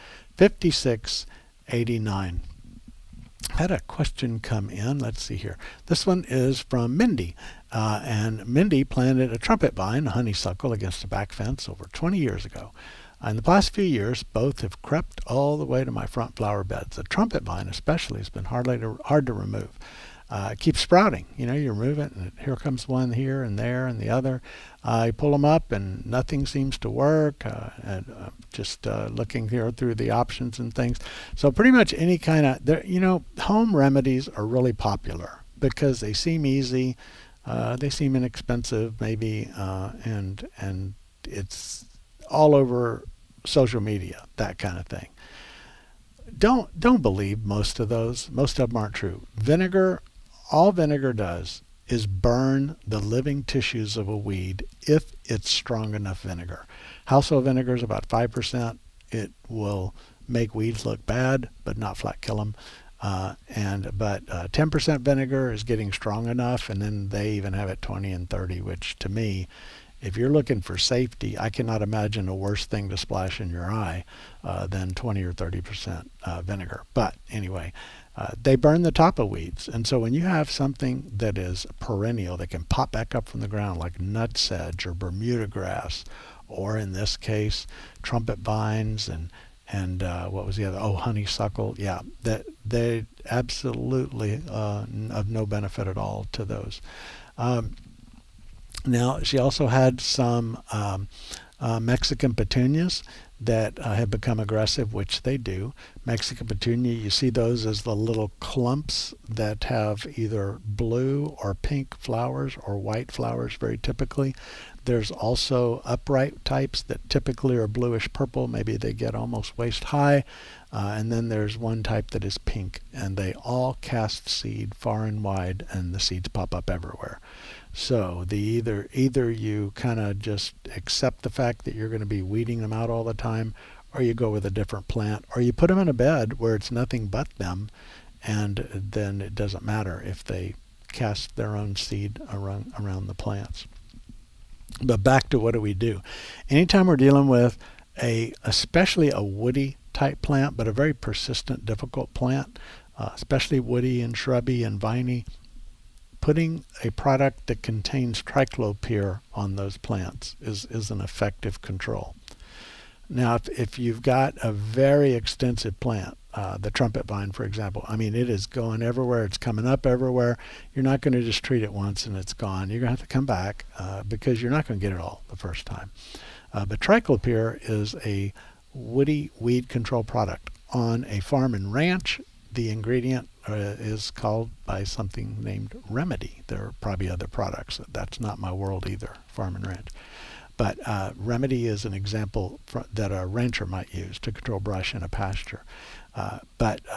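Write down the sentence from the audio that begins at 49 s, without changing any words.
Vinegar all vinegar does is burn the living tissues of a weed if it's strong enough vinegar.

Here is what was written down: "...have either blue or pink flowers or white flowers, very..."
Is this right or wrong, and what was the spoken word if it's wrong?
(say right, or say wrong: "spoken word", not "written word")
right.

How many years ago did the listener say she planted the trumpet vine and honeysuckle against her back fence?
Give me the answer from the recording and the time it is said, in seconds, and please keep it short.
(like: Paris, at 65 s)
20, at 11 s.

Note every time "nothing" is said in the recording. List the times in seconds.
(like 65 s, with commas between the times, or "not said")
26 s, 136 s.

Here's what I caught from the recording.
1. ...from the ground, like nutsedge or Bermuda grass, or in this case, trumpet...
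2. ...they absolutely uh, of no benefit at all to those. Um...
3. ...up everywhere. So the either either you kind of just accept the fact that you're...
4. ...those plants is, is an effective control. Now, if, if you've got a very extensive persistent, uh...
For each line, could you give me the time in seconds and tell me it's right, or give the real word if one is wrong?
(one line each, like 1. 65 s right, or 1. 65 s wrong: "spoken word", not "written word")
1. 83 s right
2. 92 s right
3. 126 s right
4. 159 s wrong: "plant", not "persistent".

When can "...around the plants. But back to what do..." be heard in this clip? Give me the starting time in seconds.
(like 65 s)
142 s.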